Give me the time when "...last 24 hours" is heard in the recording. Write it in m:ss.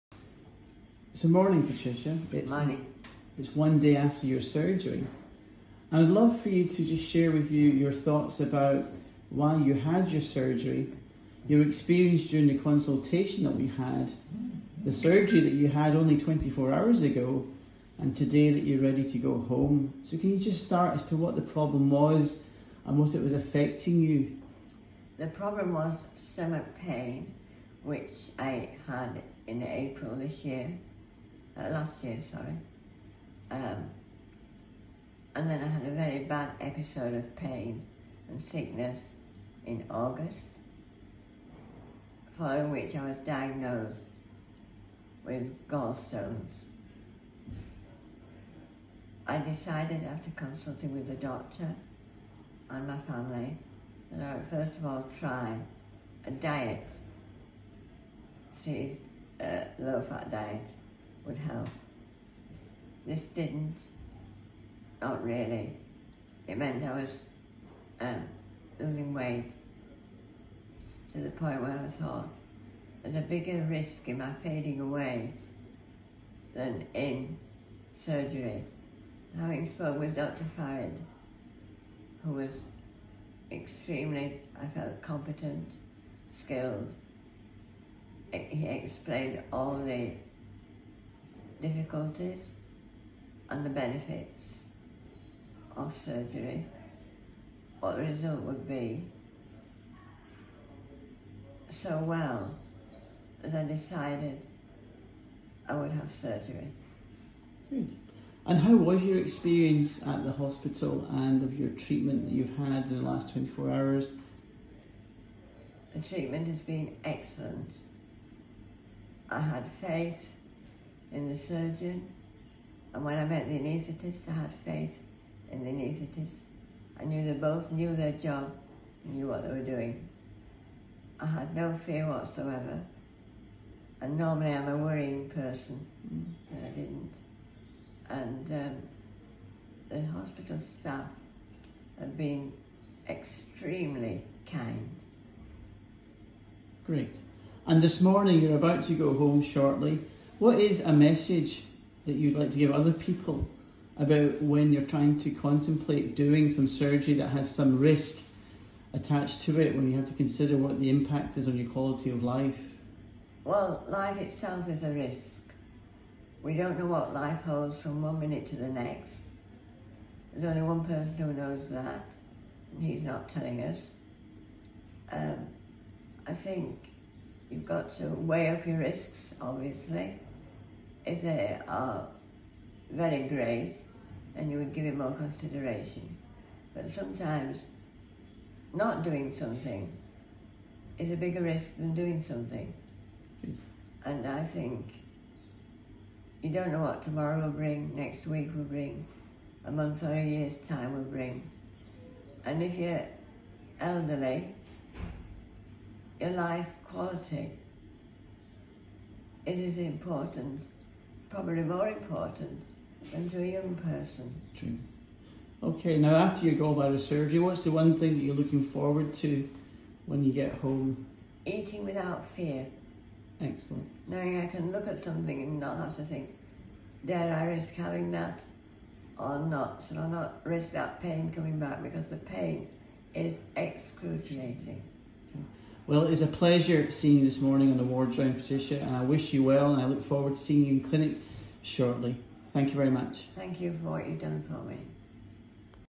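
1:53.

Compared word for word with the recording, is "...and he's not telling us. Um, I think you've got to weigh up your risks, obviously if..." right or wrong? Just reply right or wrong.
right.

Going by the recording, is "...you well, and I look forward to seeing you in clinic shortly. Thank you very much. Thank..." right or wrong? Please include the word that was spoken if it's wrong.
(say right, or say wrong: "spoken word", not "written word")
right.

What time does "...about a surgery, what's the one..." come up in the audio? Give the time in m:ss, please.
3:36.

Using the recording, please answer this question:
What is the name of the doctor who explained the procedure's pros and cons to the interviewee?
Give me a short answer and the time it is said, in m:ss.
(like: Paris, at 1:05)
Dr. Farid, at 1:20.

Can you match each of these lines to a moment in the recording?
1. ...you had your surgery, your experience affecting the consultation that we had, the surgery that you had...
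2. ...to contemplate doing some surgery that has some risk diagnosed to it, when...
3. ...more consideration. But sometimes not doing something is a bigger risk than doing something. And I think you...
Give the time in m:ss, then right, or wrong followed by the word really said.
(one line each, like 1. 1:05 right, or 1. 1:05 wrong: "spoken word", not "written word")
1. 0:09 wrong: "during", not "affecting"
2. 2:35 wrong: "attached", not "diagnosed"
3. 3:04 right.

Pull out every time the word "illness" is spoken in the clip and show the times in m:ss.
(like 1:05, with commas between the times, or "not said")
not said.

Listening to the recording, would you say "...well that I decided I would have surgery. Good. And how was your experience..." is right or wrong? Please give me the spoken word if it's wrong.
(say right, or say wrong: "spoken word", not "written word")
right.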